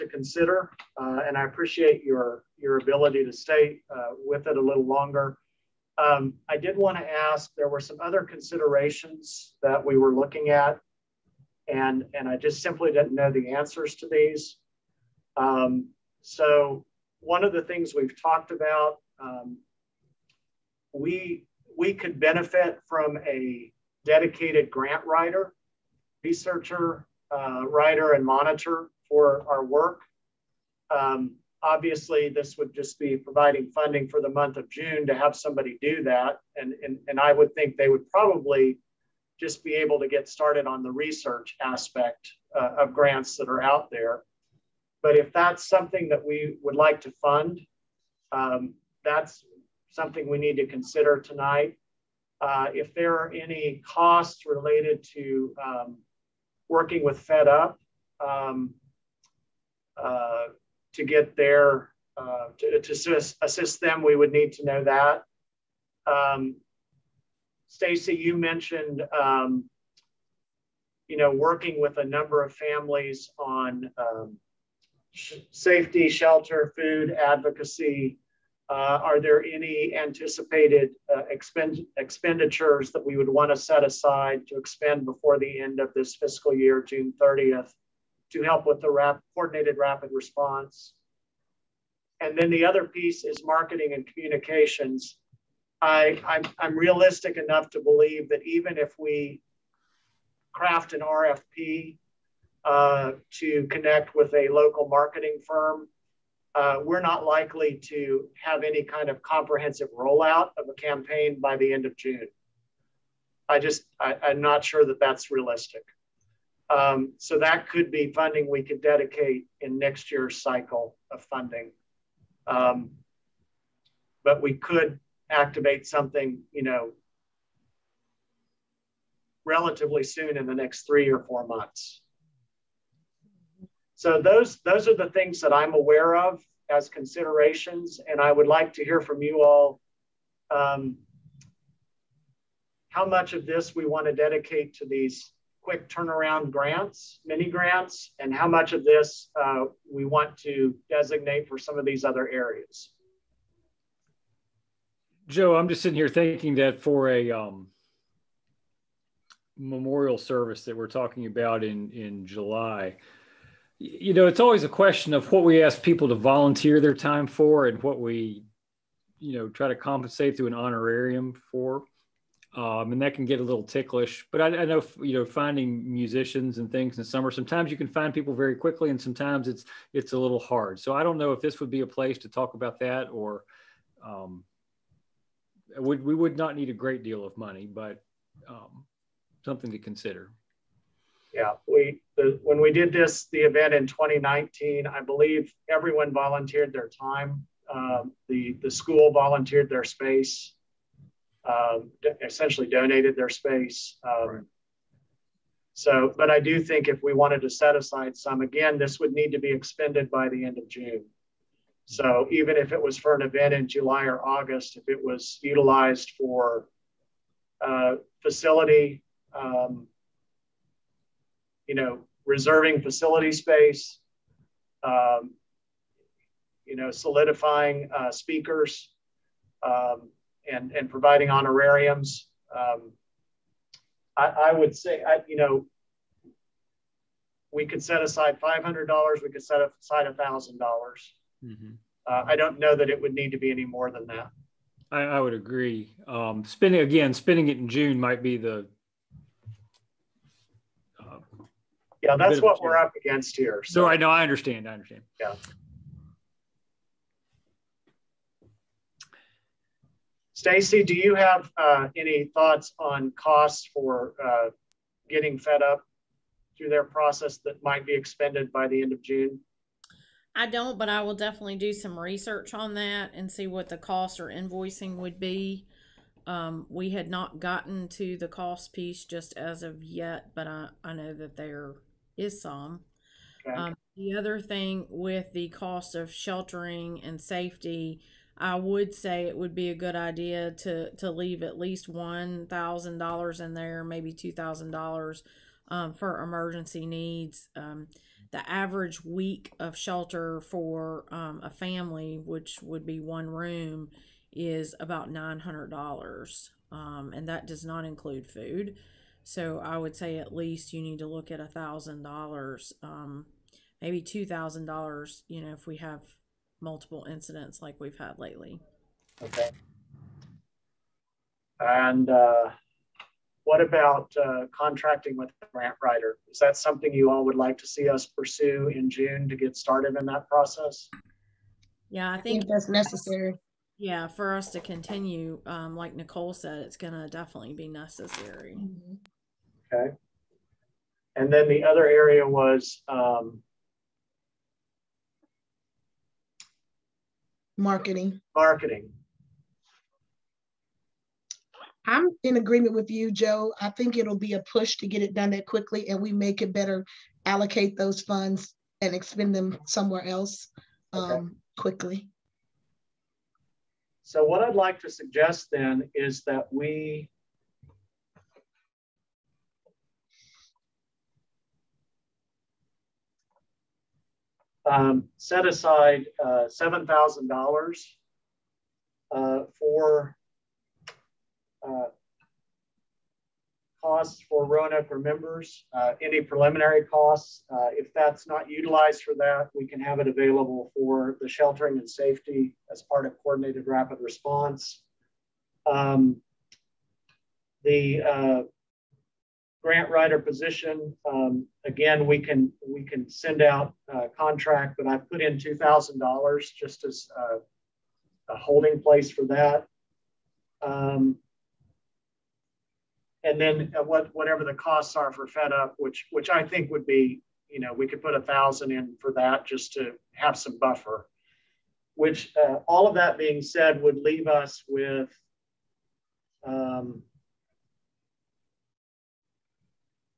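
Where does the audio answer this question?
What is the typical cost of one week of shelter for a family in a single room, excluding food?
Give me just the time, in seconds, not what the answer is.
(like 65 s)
305 s.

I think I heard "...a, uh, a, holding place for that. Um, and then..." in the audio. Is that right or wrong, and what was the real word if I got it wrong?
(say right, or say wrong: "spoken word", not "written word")
right.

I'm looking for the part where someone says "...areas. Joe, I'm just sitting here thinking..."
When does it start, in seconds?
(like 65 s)
152 s.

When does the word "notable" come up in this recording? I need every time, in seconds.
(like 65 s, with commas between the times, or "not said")
not said.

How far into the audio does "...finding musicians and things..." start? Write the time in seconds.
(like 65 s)
175 s.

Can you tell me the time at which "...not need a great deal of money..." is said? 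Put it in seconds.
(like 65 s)
186 s.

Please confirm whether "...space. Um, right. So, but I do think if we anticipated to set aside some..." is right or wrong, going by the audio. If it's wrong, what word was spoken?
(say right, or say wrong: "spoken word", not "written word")
wrong: "wanted", not "anticipated".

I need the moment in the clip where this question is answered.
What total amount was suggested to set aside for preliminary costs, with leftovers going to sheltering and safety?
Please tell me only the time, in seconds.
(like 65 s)
376 s.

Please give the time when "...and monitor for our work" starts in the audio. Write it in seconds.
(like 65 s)
28 s.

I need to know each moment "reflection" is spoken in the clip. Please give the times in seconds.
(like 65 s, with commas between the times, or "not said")
not said.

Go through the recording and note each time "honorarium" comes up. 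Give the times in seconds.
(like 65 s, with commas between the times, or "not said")
170 s, 231 s.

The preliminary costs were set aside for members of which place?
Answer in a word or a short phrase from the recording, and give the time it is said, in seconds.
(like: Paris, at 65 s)
Roanoke, at 384 s.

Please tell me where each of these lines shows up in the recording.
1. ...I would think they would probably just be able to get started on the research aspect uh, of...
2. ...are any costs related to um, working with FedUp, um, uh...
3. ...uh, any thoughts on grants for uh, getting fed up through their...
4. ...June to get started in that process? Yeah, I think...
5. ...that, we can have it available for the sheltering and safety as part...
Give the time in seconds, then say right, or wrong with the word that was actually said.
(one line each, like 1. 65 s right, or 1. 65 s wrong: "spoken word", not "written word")
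1. 37 s right
2. 53 s right
3. 261 s wrong: "costs", not "grants"
4. 328 s right
5. 389 s right.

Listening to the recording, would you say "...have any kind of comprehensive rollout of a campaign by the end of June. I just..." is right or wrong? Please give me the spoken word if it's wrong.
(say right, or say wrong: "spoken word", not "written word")
right.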